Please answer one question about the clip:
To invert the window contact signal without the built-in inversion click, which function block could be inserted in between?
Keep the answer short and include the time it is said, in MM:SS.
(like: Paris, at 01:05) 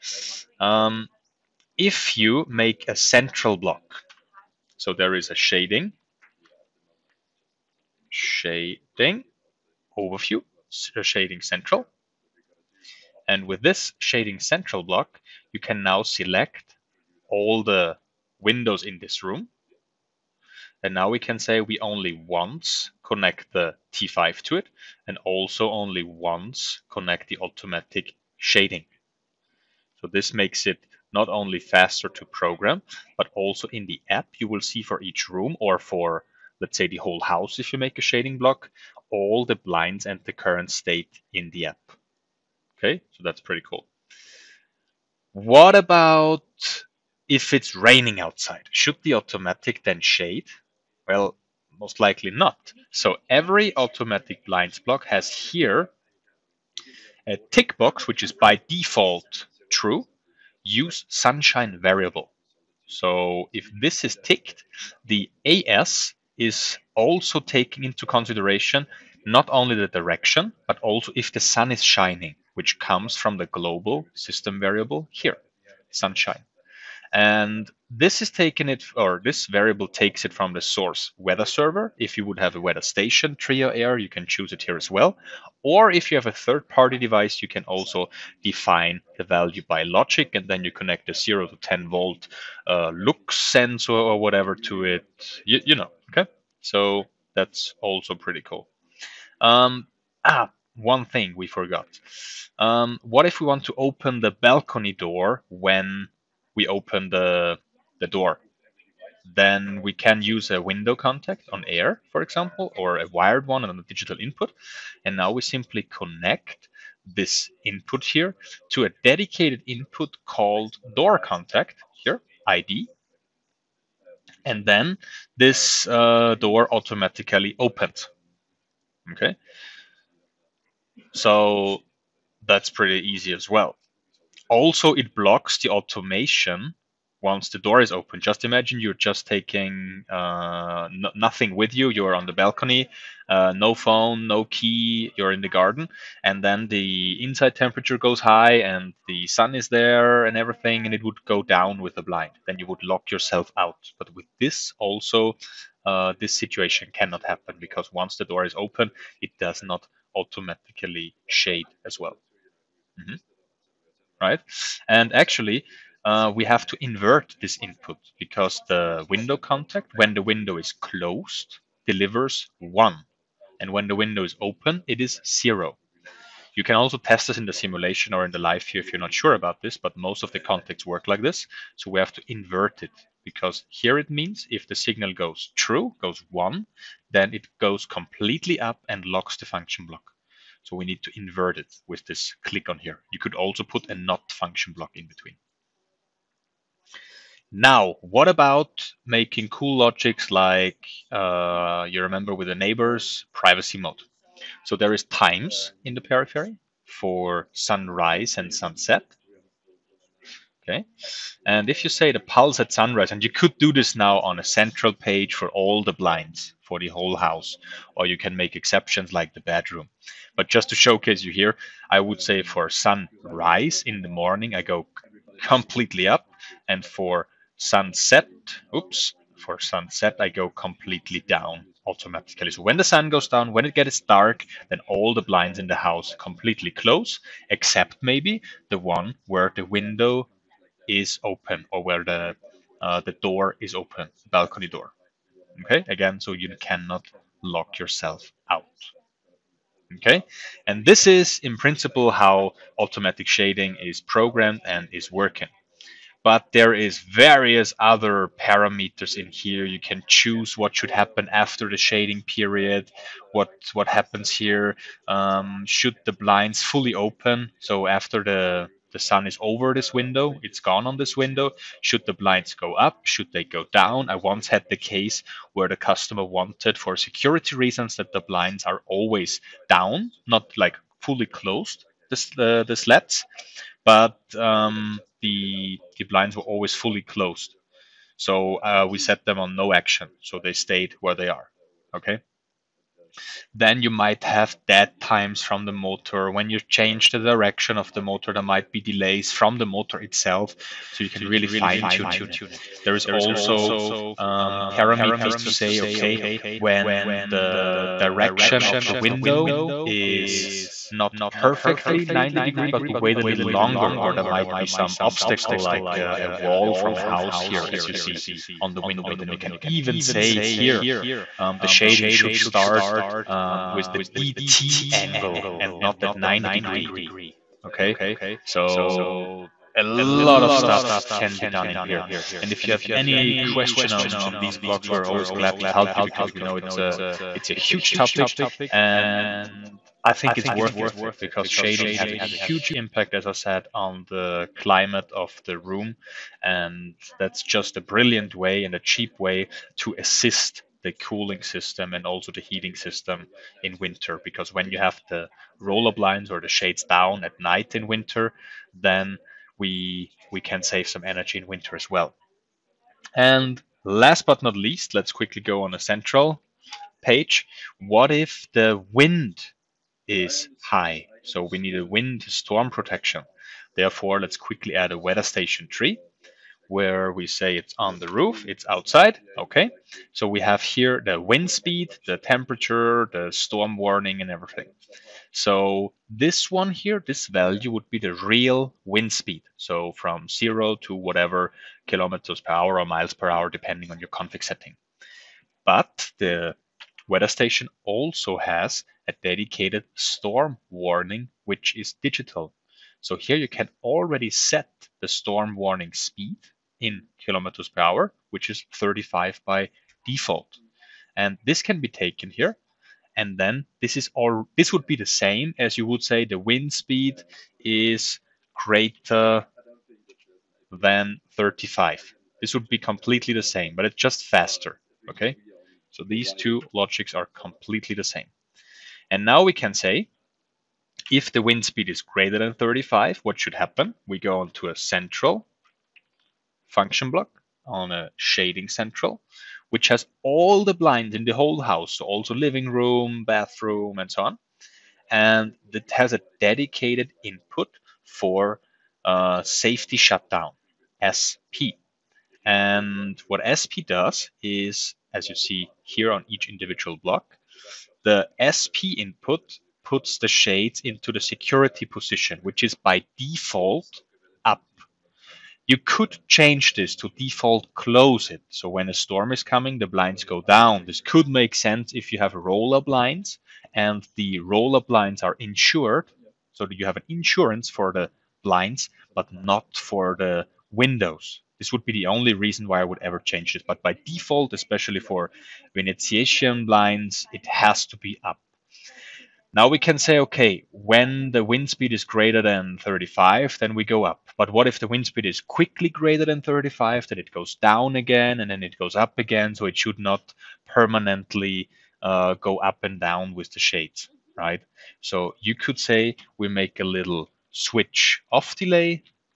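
Not function block, at 03:13.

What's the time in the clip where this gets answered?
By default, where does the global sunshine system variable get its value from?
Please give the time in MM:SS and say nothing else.
01:21.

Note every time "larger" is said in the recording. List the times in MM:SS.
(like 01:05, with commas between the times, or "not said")
not said.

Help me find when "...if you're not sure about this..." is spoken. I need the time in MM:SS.
02:58.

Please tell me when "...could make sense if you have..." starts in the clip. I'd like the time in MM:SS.
07:51.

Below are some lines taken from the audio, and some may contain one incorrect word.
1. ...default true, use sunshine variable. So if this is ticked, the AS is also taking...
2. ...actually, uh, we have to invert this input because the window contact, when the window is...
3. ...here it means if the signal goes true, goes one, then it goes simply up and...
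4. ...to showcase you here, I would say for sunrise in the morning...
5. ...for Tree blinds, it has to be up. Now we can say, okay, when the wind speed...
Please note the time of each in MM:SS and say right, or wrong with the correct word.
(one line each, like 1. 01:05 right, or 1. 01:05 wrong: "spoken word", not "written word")
1. 00:58 right
2. 02:45 right
3. 03:03 wrong: "completely", not "simply"
4. 03:40 right
5. 08:04 wrong: "Venetian", not "Tree".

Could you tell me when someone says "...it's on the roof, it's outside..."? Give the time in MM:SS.
06:17.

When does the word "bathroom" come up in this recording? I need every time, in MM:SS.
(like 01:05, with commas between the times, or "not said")
07:23.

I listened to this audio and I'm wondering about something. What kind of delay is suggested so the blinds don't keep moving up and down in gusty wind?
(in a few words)
Switch off delay.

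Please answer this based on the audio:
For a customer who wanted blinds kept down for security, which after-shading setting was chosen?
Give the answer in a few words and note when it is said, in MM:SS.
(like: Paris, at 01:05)
No action, at 04:49.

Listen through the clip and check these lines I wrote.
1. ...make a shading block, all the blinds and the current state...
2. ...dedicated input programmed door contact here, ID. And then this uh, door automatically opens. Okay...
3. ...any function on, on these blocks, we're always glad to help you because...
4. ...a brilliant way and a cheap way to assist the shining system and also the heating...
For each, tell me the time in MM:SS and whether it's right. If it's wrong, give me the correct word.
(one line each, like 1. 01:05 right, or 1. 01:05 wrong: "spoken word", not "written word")
1. 00:37 right
2. 01:59 wrong: "called", not "programmed"
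3. 05:32 wrong: "question", not "function"
4. 05:47 wrong: "cooling", not "shining".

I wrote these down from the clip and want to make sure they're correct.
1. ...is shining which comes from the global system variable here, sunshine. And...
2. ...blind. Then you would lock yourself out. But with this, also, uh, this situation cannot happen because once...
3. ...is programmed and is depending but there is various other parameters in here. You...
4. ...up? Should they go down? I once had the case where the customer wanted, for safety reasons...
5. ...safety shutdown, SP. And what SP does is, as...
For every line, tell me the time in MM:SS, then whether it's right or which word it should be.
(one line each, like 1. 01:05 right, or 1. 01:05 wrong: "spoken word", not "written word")
1. 01:11 right
2. 02:32 right
3. 04:13 wrong: "working", not "depending"
4. 04:32 wrong: "security", not "safety"
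5. 07:29 right.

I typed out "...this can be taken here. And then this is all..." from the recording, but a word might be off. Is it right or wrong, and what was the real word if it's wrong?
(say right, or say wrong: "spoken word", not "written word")
right.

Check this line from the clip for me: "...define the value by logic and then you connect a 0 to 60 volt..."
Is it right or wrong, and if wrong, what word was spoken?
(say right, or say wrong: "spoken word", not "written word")
wrong: "10", not "60".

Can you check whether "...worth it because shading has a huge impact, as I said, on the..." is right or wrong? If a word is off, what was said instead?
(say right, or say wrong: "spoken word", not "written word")
right.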